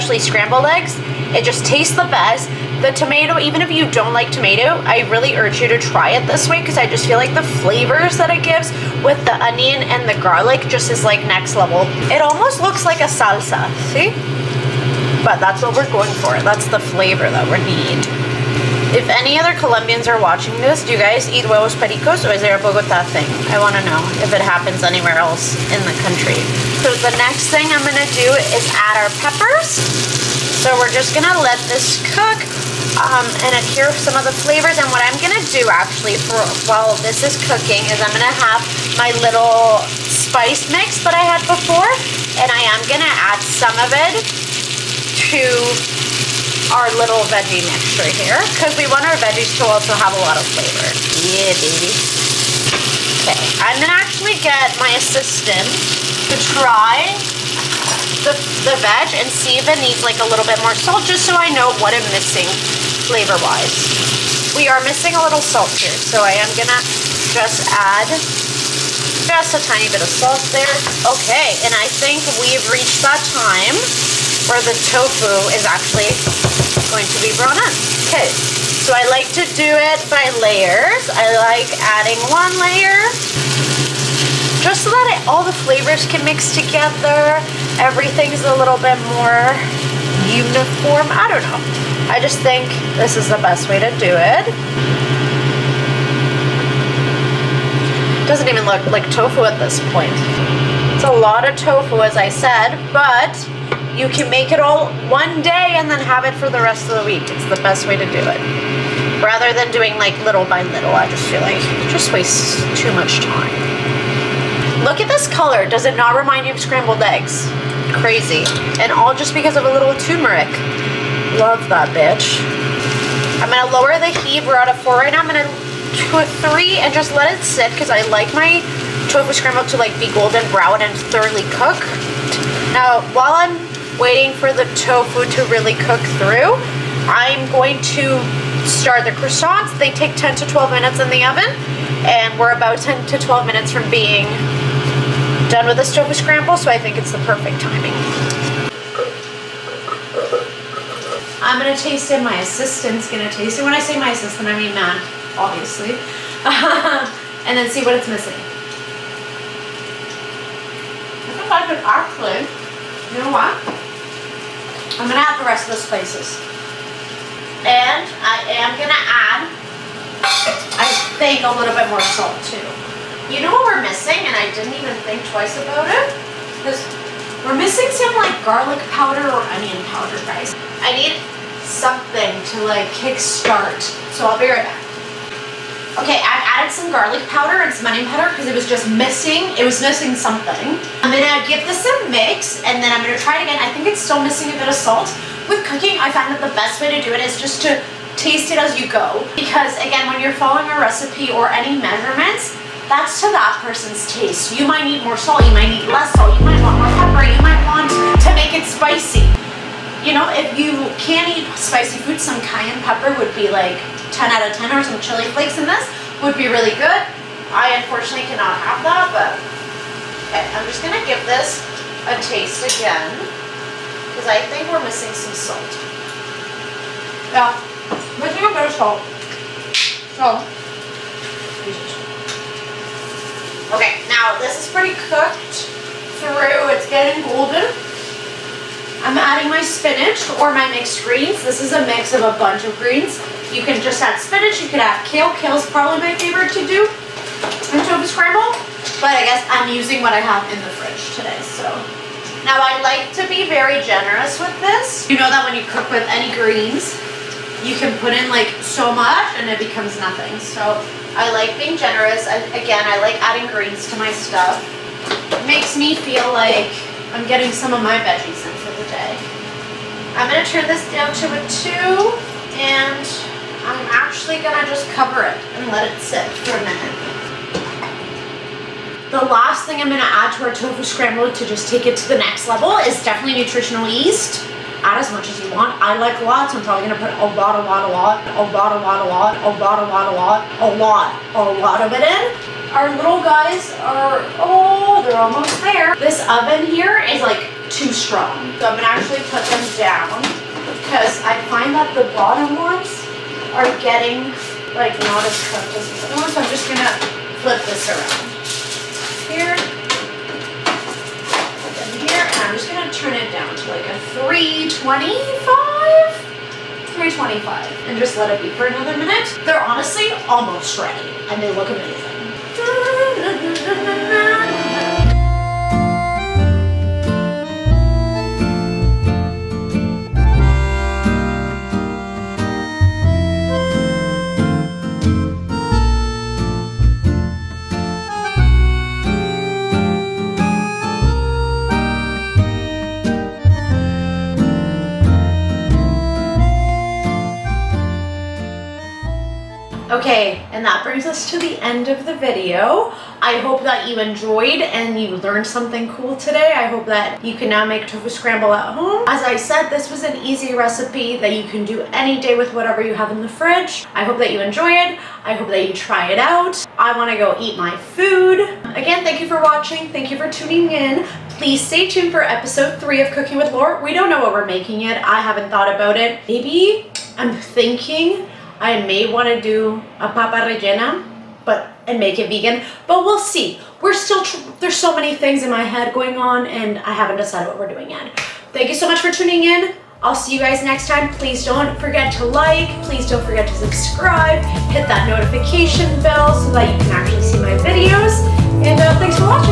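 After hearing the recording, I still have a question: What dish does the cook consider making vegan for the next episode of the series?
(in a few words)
papa rellena.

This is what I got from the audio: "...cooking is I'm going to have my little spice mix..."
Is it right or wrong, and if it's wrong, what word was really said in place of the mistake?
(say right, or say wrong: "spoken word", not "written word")
right.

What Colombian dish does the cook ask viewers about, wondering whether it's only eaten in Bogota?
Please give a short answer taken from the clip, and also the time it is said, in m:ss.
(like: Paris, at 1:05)
huevos pericos, at 0:21.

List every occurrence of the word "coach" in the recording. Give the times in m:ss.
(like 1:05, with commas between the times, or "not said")
not said.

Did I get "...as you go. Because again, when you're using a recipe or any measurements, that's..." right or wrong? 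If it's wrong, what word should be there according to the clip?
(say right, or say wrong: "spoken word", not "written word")
wrong: "following", not "using".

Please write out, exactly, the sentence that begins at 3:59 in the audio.
I'm adding my spinach or my mixed greens.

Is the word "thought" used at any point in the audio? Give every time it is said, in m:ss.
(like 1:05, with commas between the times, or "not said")
6:15.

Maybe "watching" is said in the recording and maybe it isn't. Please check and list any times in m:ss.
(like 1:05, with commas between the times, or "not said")
0:20, 6:09.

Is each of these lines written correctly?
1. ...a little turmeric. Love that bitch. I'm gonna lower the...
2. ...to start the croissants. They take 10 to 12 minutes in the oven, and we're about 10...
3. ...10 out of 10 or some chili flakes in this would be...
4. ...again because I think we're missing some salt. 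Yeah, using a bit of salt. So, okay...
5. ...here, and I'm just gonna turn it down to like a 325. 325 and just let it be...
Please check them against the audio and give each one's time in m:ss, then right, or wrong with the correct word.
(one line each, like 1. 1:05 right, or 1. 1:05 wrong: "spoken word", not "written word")
1. 1:59 right
2. 2:17 right
3. 3:34 right
4. 3:42 wrong: "missing", not "using"
5. 5:11 right.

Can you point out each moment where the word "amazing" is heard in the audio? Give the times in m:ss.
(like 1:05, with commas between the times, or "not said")
5:21.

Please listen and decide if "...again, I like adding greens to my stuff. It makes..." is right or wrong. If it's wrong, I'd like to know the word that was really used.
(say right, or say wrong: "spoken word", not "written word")
right.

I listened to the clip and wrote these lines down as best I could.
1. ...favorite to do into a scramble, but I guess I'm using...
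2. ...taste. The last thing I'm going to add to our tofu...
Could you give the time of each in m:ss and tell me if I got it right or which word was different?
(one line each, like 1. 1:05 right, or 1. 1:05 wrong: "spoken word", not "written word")
1. 4:06 right
2. 4:36 wrong: "minute", not "taste".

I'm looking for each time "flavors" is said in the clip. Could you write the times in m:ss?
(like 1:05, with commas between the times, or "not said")
0:07, 0:16, 0:34, 0:50, 1:03, 1:25.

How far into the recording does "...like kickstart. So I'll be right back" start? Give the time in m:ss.
3:02.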